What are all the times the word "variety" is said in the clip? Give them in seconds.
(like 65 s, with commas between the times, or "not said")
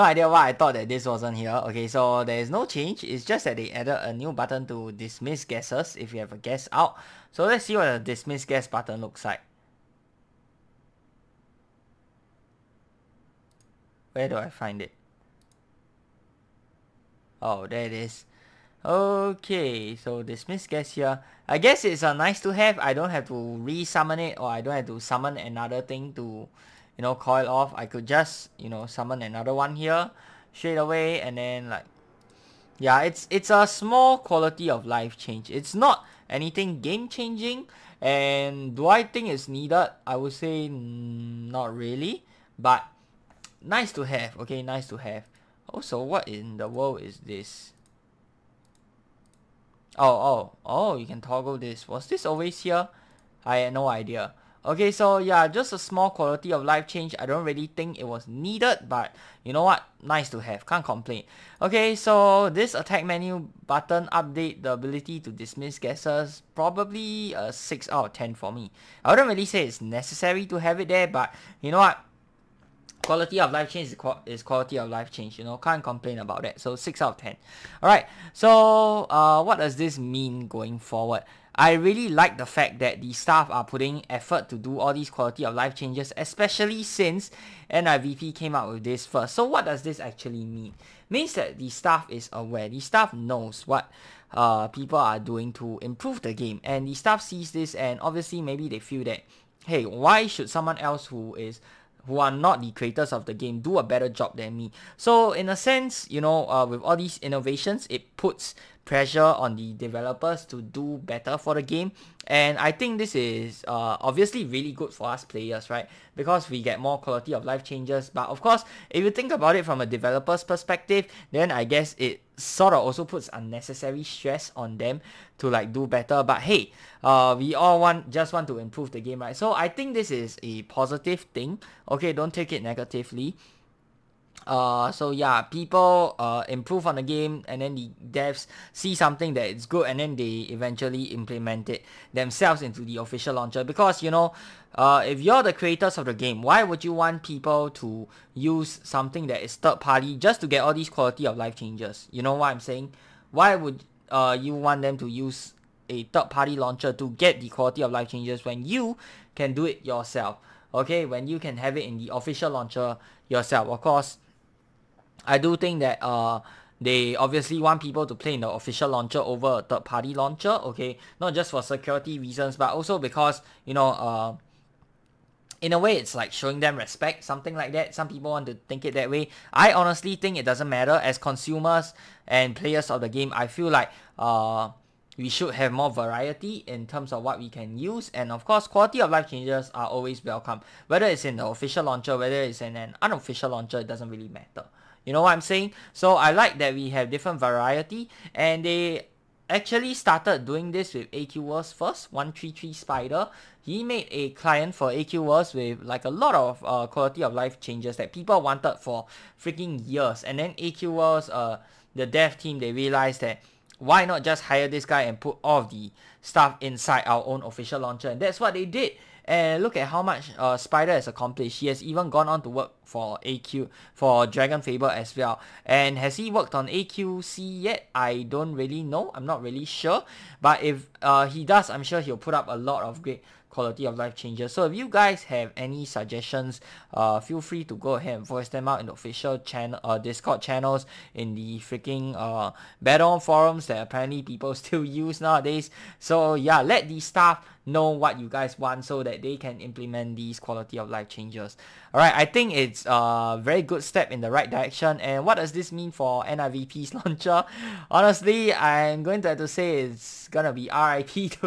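185 s, 197 s.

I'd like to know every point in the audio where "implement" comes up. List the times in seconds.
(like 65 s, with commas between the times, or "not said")
141 s, 249 s.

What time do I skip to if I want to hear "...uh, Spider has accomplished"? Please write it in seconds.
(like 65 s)
220 s.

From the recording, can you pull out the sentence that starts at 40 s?
I would say mm, not really, but nice to have.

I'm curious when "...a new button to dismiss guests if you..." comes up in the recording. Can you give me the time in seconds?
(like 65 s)
4 s.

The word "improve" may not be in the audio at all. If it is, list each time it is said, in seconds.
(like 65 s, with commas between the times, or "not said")
95 s, 128 s, 136 s.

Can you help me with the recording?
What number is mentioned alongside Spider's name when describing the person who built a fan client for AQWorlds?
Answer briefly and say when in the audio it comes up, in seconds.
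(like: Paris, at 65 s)
133, at 202 s.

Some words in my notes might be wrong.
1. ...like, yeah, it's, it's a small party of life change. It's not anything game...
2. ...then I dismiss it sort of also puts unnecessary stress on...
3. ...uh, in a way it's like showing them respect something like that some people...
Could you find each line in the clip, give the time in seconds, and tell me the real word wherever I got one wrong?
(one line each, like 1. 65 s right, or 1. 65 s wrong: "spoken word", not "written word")
1. 31 s wrong: "quality", not "party"
2. 121 s wrong: "guess", not "dismiss"
3. 173 s right.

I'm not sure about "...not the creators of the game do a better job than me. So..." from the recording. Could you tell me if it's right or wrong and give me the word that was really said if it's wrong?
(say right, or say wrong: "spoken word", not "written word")
right.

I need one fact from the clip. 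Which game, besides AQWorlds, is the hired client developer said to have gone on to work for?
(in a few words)
Dragon Fable.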